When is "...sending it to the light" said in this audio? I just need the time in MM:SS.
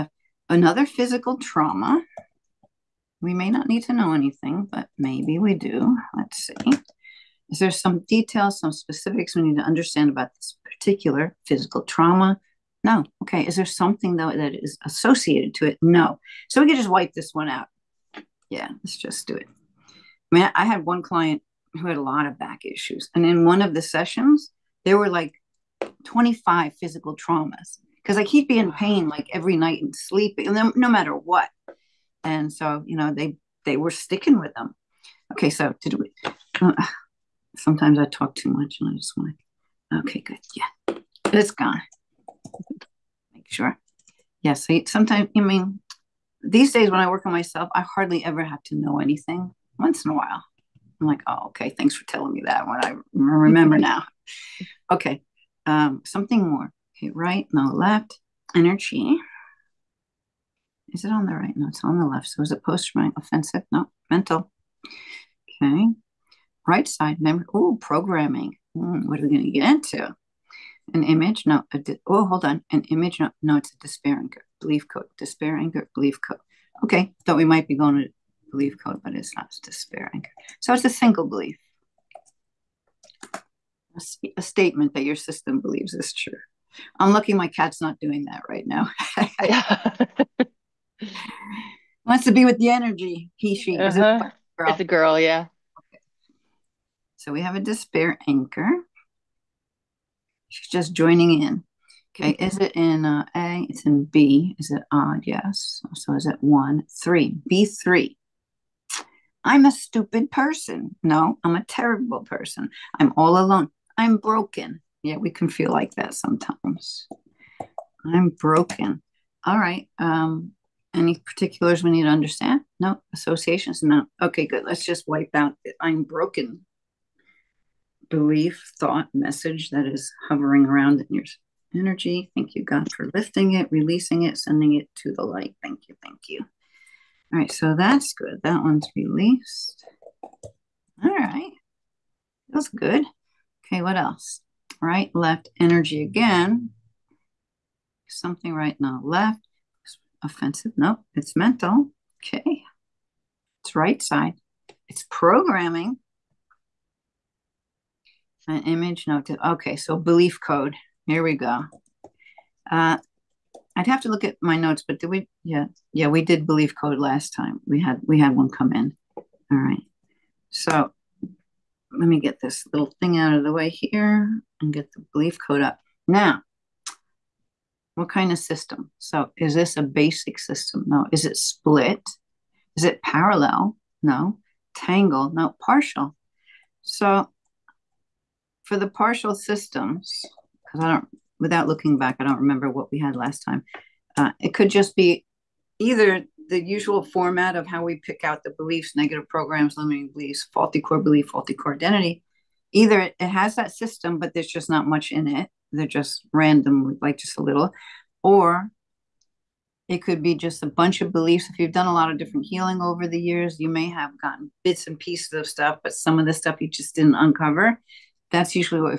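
02:14.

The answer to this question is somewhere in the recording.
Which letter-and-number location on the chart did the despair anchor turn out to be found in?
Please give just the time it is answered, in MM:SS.
01:47.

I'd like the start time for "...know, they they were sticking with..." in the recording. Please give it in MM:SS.
00:32.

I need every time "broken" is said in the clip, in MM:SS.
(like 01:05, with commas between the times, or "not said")
01:54, 01:58, 02:06.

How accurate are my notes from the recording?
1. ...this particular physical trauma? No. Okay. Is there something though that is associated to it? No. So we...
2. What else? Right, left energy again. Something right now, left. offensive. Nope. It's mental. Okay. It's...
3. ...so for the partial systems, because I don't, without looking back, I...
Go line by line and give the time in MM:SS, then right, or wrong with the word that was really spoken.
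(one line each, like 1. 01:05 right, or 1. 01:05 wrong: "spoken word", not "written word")
1. 00:10 right
2. 02:23 right
3. 03:06 right.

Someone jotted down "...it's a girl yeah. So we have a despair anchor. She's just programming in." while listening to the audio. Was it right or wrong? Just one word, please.
wrong.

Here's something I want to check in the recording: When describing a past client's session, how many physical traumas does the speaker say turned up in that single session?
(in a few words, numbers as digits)
25.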